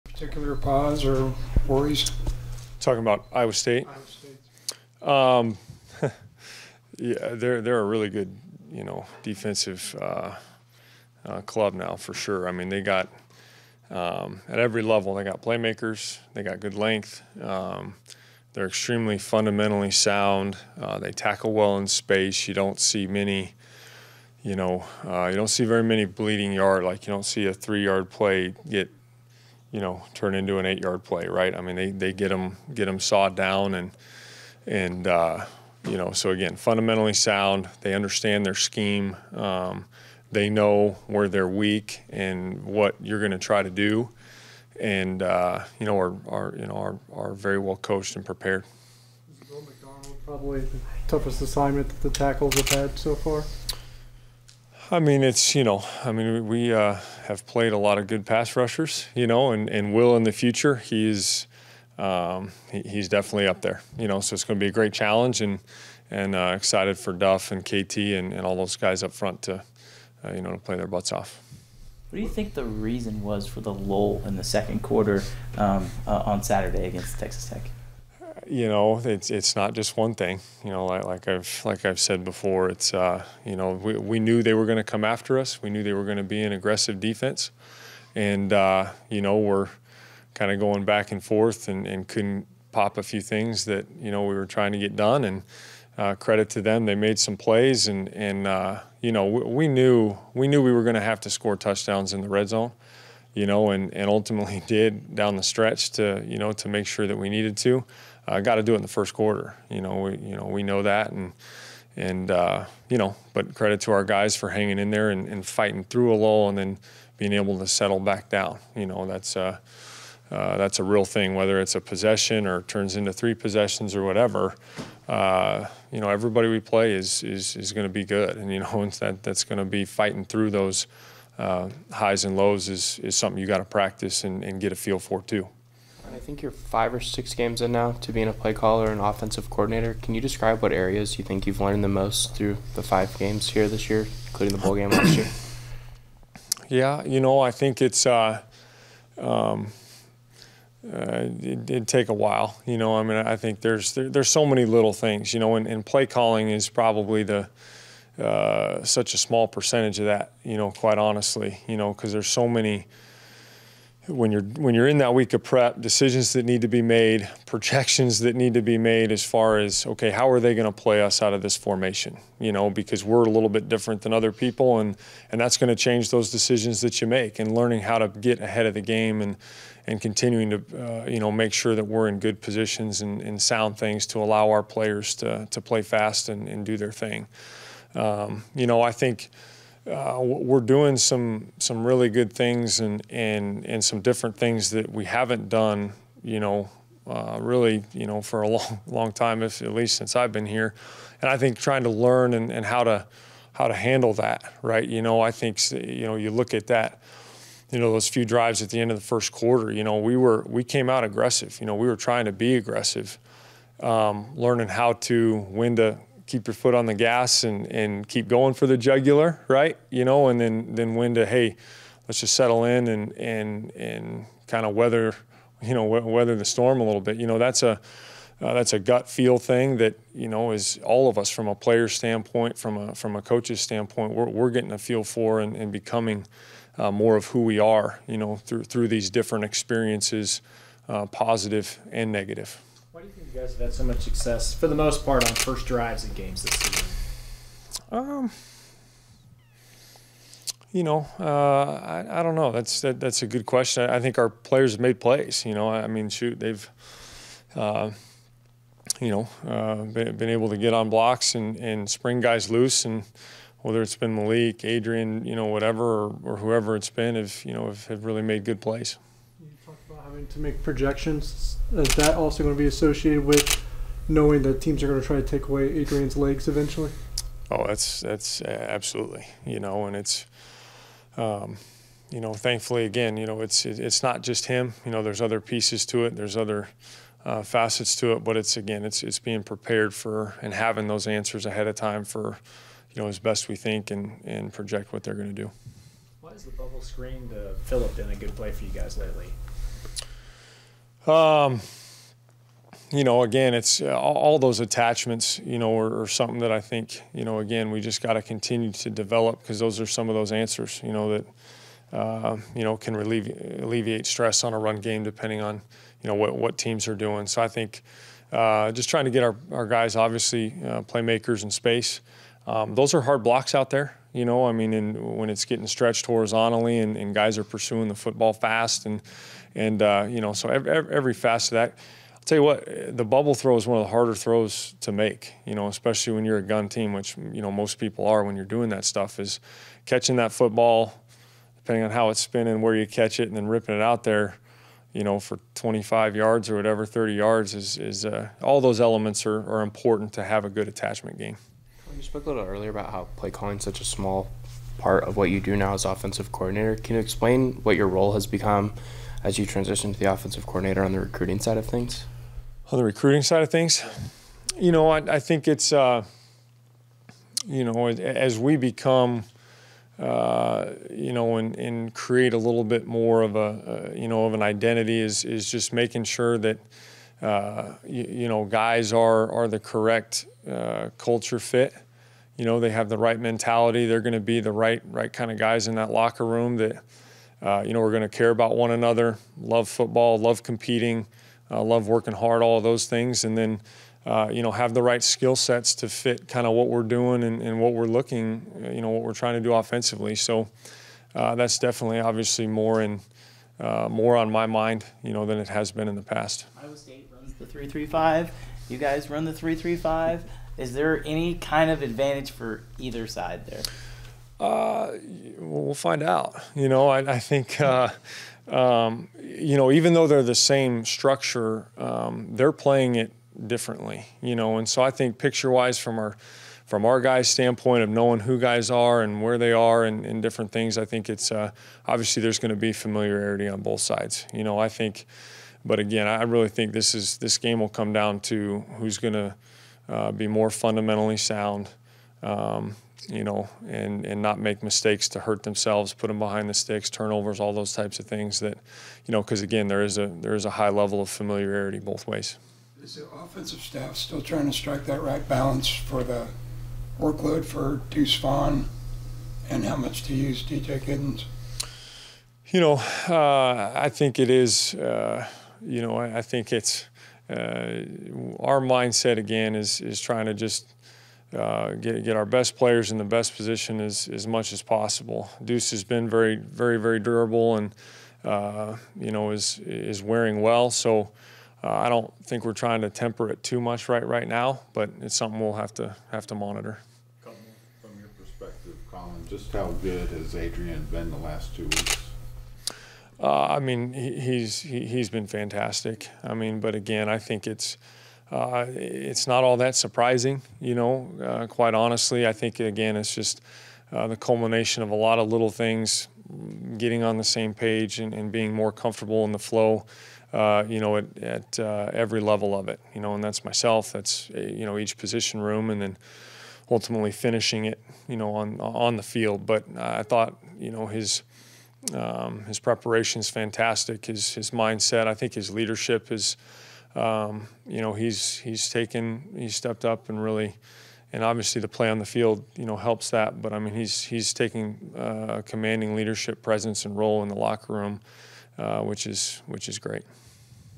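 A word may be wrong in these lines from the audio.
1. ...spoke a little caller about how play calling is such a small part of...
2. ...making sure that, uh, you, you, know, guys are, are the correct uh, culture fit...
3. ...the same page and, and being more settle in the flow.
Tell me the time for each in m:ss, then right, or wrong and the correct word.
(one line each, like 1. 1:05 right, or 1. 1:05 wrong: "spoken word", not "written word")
1. 5:52 wrong: "earlier", not "caller"
2. 6:15 right
3. 8:27 wrong: "comfortable", not "settle".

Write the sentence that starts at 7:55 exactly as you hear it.
Deuce has been very, very, very durable and, uh, you know, is, is wearing well.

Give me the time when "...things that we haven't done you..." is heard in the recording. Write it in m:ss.
3:14.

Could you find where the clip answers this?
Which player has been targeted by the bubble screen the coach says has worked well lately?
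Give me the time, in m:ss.
4:57.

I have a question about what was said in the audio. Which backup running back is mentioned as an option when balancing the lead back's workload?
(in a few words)
DJ Giddens.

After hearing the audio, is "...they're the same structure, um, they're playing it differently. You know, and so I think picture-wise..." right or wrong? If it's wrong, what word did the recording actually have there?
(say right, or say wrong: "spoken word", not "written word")
right.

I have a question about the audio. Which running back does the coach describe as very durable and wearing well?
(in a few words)
Deuce Vaughn.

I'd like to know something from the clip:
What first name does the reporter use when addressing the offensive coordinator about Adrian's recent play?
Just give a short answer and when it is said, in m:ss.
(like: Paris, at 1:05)
Collin, at 8:08.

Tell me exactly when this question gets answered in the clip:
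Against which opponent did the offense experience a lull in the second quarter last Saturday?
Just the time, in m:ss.
1:17.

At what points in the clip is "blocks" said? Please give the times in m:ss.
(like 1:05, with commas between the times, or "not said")
4:20, 5:23.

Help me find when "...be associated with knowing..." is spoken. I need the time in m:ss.
4:32.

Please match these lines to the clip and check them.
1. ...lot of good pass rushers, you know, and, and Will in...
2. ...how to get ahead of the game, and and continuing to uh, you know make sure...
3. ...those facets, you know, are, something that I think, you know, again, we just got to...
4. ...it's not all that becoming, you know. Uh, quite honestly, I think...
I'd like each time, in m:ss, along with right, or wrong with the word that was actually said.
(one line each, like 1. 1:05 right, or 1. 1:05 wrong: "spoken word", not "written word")
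1. 0:57 right
2. 2:57 right
3. 5:04 wrong: "attachments", not "facets"
4. 8:18 wrong: "surprising", not "becoming".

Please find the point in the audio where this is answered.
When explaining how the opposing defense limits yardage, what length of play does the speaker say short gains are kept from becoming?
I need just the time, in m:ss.
0:30.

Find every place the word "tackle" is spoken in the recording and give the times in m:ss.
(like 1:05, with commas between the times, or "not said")
0:21, 0:52.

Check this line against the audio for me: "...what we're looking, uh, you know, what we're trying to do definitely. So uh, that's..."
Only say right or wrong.
wrong.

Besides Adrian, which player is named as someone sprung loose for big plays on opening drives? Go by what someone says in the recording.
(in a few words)
Malik.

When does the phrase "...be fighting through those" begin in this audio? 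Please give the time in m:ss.
2:09.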